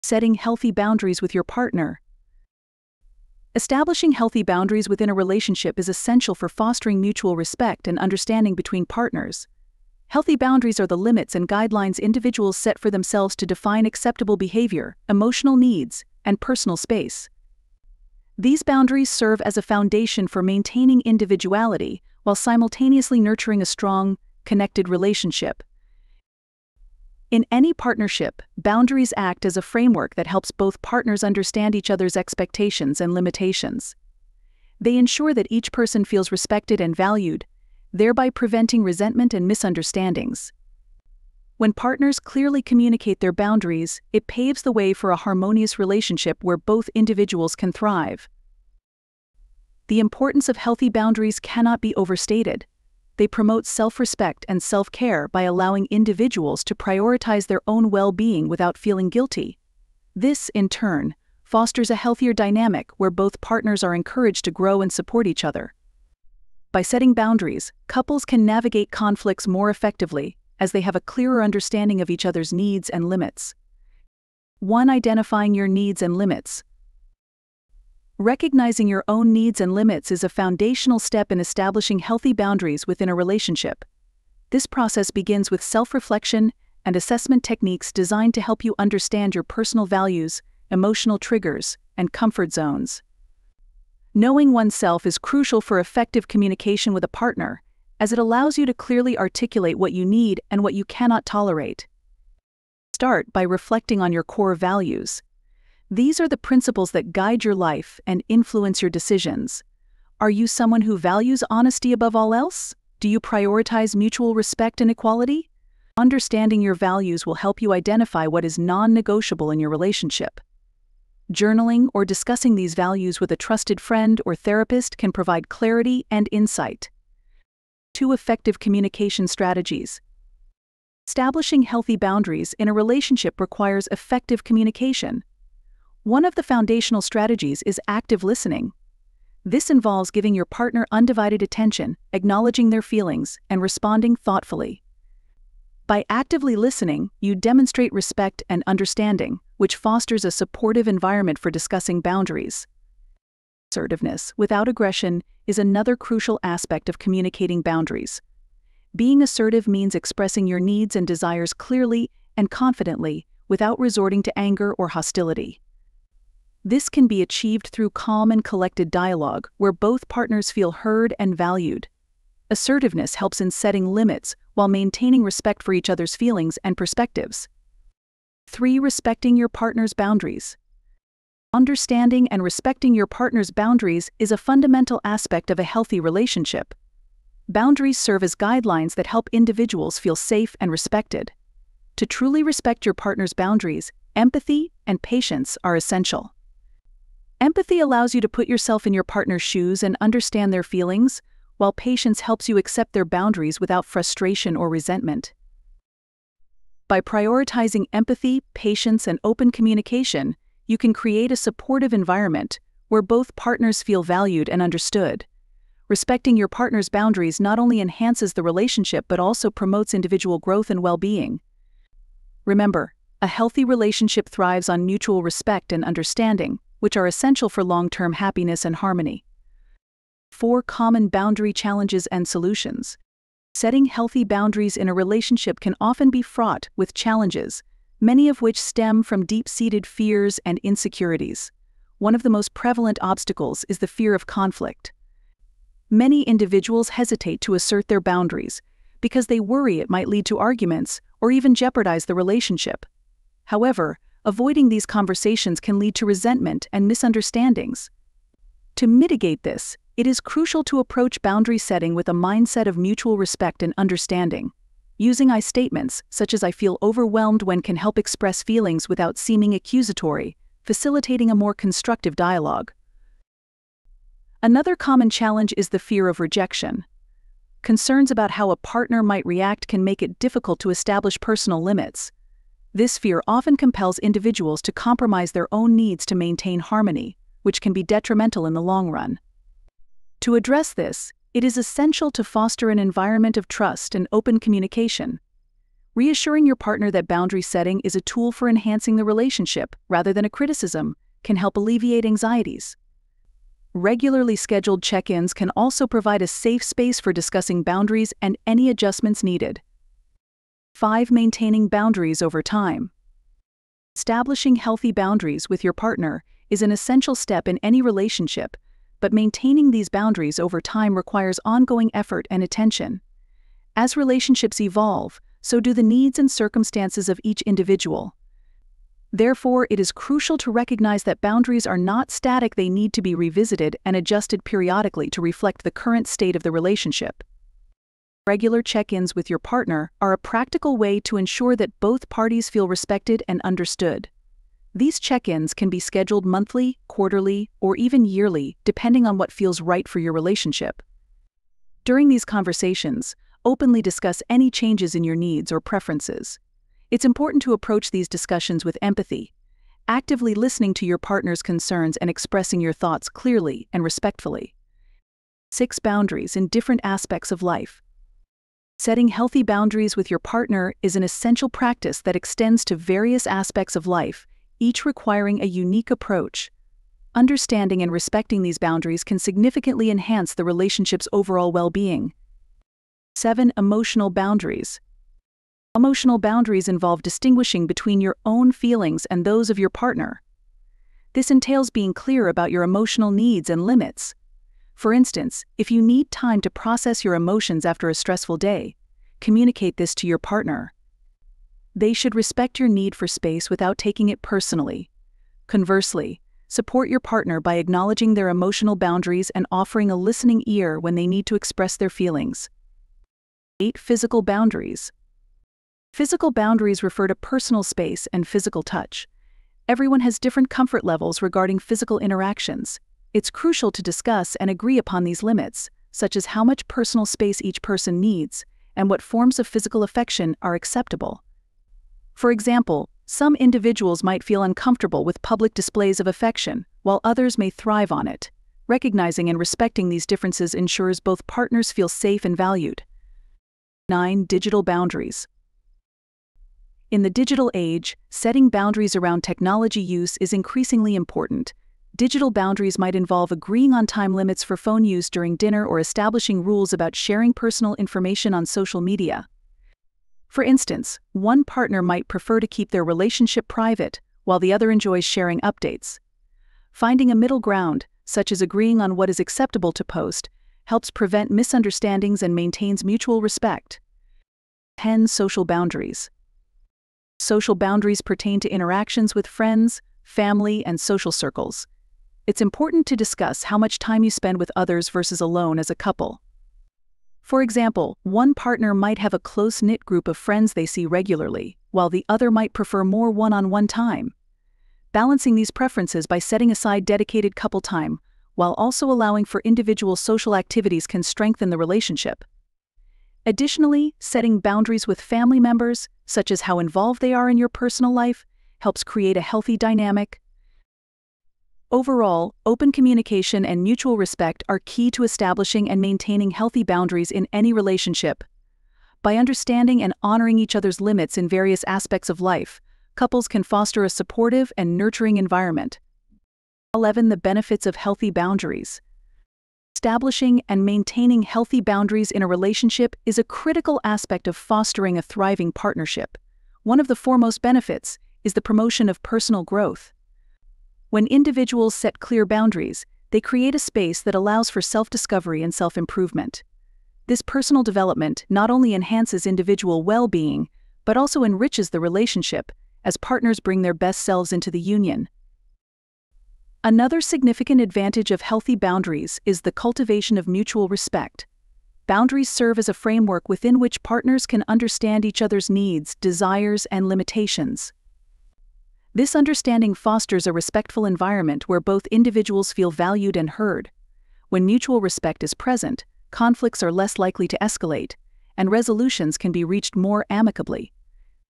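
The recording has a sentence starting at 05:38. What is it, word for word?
Regular check ins with your partner are a practical way to ensure that both parties feel respected and understood.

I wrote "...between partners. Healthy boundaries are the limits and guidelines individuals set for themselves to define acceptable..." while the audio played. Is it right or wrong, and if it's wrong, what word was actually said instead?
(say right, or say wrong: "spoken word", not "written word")
right.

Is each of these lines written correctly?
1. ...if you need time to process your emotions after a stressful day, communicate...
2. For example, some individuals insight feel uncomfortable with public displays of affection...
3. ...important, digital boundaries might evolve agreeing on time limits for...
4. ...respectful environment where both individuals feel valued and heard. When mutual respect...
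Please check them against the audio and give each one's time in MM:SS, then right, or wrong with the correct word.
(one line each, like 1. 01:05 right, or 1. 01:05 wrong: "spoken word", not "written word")
1. 06:35 right
2. 07:12 wrong: "might", not "insight"
3. 07:30 wrong: "involve", not "evolve"
4. 09:30 right.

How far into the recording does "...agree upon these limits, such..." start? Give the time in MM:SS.
07:04.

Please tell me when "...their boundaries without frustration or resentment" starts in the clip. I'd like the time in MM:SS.
03:22.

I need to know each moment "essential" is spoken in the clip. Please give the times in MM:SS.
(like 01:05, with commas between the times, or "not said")
00:05, 03:15, 03:47, 04:51, 05:16, 06:11.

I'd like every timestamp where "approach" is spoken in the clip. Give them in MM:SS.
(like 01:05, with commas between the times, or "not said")
04:20, 05:57, 06:15.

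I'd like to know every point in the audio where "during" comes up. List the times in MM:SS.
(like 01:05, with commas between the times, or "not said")
05:51, 07:35.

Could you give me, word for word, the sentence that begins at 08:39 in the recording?
By understanding and honoring each other's limits in various aspects of life, couples can foster a supportive and nurturing environment.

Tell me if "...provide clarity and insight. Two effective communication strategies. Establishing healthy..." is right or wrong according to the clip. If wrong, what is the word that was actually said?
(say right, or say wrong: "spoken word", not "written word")
right.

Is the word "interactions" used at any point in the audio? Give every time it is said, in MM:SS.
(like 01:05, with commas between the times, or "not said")
07:01, 07:58.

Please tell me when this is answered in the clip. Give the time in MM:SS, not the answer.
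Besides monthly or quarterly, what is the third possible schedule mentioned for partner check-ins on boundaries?
05:48.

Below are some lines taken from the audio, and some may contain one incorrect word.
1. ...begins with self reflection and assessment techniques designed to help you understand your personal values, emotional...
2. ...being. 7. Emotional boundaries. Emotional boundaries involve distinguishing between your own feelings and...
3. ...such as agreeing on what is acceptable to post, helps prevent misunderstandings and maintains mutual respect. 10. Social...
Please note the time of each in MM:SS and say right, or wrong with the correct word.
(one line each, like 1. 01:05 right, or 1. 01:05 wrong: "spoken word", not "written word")
1. 01:25 right
2. 06:21 right
3. 07:48 right.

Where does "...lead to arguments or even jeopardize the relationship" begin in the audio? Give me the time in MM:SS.
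04:10.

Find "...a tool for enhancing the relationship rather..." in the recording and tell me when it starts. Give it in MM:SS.
04:57.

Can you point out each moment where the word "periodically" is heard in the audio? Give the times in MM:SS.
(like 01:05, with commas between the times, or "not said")
05:34.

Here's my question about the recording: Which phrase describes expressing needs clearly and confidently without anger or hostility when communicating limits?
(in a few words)
Assertiveness without aggression.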